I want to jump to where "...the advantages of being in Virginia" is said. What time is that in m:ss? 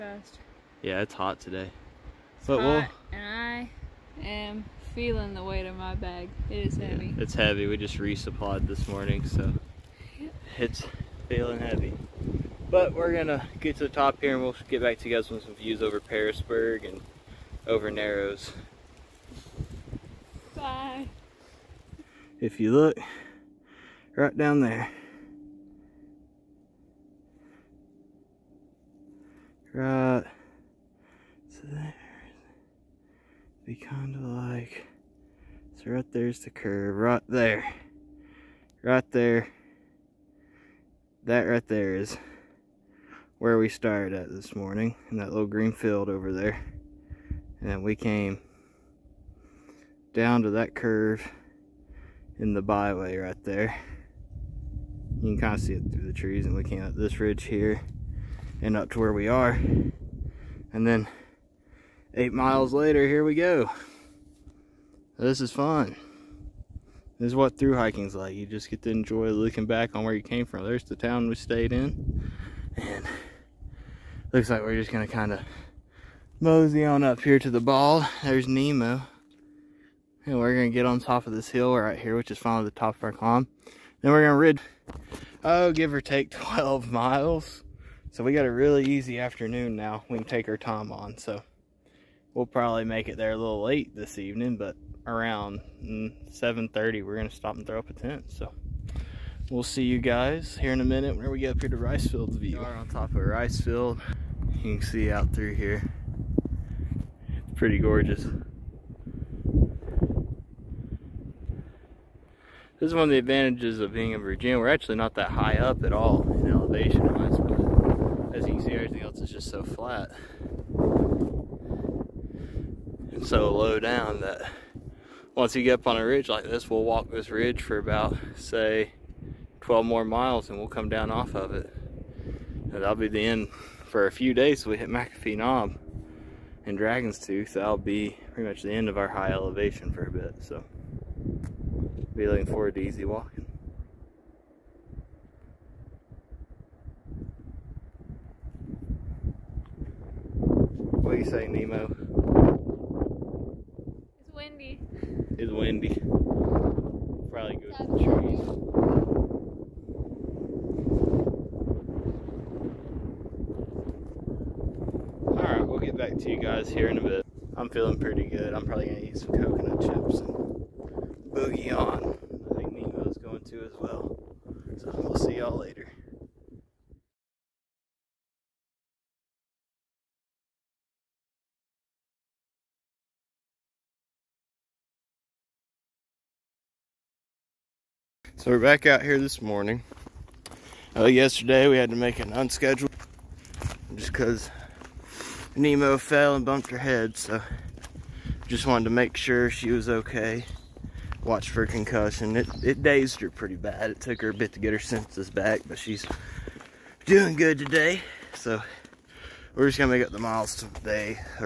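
1:53.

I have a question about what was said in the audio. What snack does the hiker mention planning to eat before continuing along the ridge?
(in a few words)
Coconut chips.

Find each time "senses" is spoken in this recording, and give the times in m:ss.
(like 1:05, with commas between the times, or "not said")
3:24.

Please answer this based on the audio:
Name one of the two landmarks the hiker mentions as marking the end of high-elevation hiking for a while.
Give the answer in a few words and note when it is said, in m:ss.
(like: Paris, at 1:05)
McAfee Knob, at 2:14.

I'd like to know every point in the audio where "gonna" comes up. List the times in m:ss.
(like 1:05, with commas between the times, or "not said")
1:14, 3:29.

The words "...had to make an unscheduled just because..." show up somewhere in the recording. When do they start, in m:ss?
3:11.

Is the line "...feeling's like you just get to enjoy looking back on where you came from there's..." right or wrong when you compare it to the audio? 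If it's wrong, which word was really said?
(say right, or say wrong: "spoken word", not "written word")
wrong: "hiking", not "feeling".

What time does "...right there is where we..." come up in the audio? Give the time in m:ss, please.
0:41.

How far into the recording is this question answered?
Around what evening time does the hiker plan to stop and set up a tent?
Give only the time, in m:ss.
1:36.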